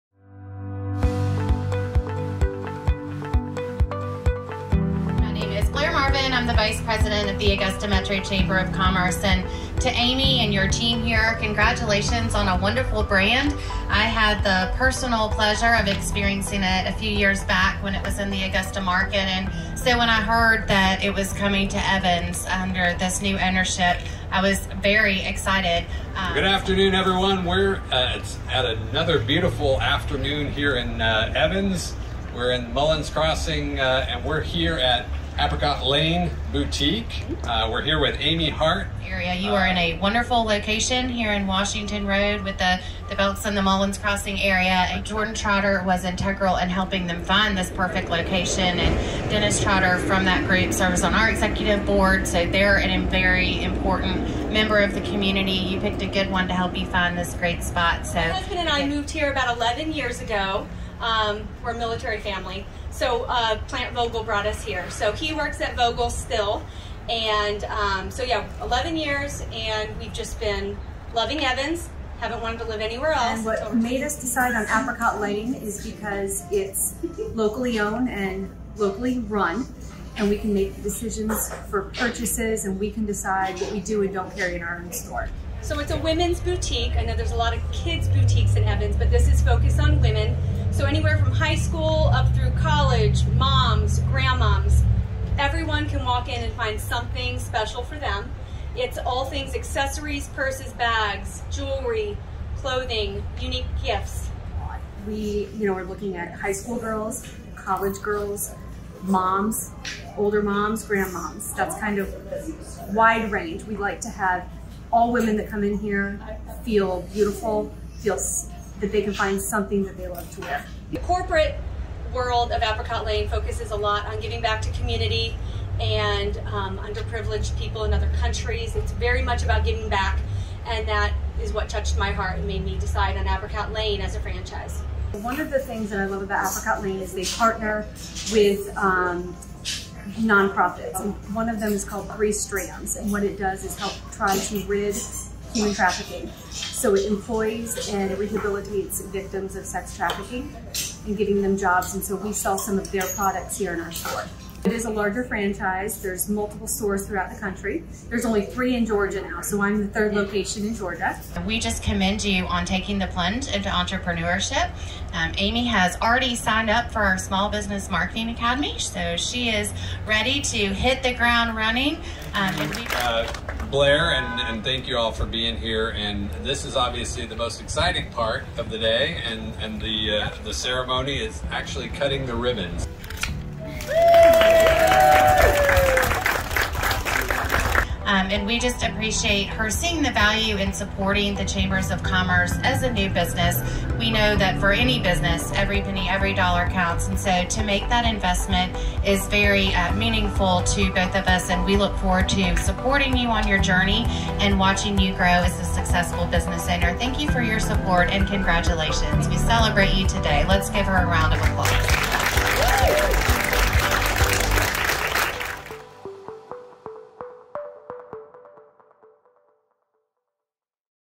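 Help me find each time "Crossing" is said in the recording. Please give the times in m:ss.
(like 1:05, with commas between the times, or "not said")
0:33, 0:43.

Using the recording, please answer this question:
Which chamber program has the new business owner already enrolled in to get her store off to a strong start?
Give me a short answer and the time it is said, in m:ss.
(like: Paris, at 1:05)
Small Business Marketing Academy, at 2:47.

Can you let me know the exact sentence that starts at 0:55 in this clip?
You picked a good one to help you find this great spot.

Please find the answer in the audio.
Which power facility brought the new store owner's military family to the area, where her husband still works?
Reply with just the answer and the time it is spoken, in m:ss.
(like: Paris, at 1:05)
Plant Vogtle, at 1:03.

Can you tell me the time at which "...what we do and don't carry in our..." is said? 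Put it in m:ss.
1:23.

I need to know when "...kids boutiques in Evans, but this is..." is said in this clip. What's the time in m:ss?
1:27.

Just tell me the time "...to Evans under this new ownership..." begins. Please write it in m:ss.
0:21.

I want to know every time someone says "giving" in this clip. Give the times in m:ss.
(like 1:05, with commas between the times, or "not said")
2:04, 2:09, 2:31.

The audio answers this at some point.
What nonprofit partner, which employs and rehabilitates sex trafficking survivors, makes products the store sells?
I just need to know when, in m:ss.
2:22.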